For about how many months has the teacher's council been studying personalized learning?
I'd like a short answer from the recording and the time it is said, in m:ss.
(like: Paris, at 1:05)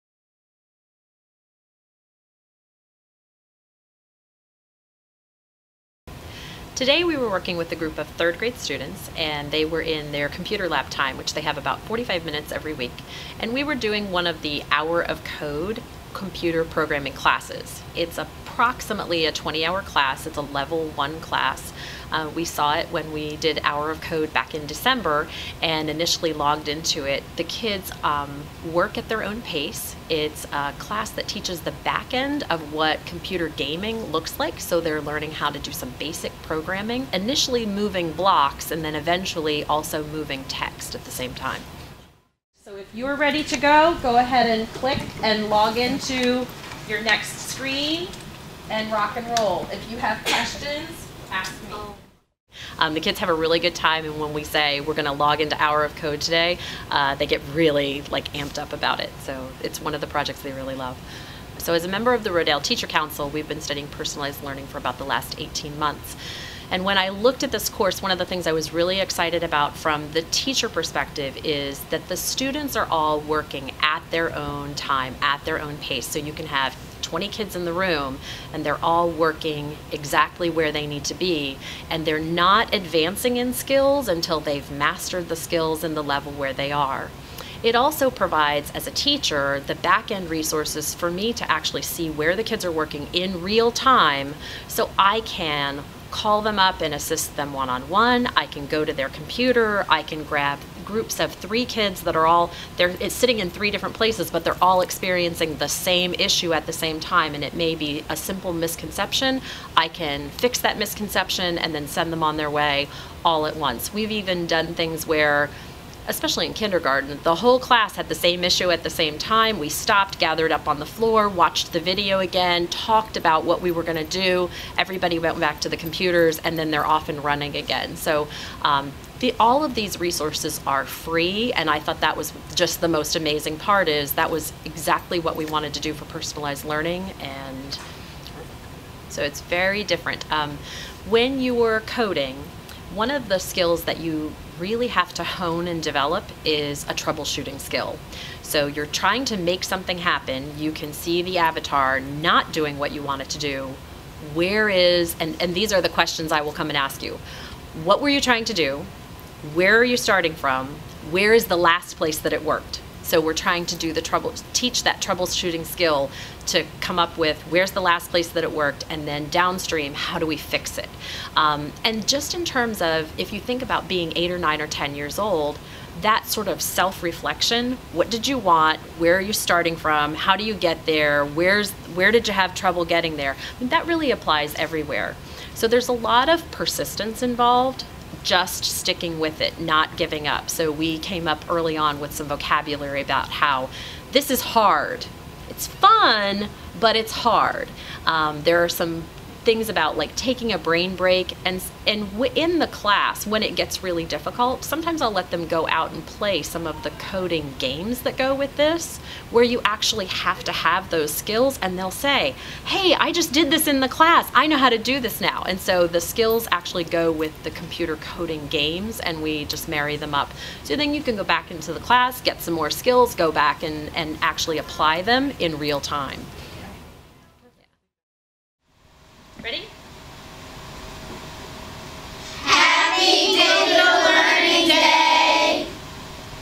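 18 months, at 1:05.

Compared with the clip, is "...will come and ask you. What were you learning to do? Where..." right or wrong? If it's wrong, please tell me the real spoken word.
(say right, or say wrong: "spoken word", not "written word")
wrong: "trying", not "learning".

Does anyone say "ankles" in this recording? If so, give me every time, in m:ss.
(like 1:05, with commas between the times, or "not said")
not said.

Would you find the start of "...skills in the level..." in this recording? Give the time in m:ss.
1:25.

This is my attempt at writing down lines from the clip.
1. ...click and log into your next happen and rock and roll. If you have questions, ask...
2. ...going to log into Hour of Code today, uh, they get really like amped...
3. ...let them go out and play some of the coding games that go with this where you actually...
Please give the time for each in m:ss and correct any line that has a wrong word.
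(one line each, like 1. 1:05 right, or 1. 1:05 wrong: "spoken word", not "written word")
1. 0:44 wrong: "screen", not "happen"
2. 0:54 right
3. 3:25 right.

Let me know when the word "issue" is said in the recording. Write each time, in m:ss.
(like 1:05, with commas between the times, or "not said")
1:46, 1:58.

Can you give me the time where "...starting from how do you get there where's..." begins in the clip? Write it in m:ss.
2:59.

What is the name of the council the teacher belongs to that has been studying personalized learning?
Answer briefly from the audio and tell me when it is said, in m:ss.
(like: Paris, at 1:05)
Rodel Teacher Council, at 1:02.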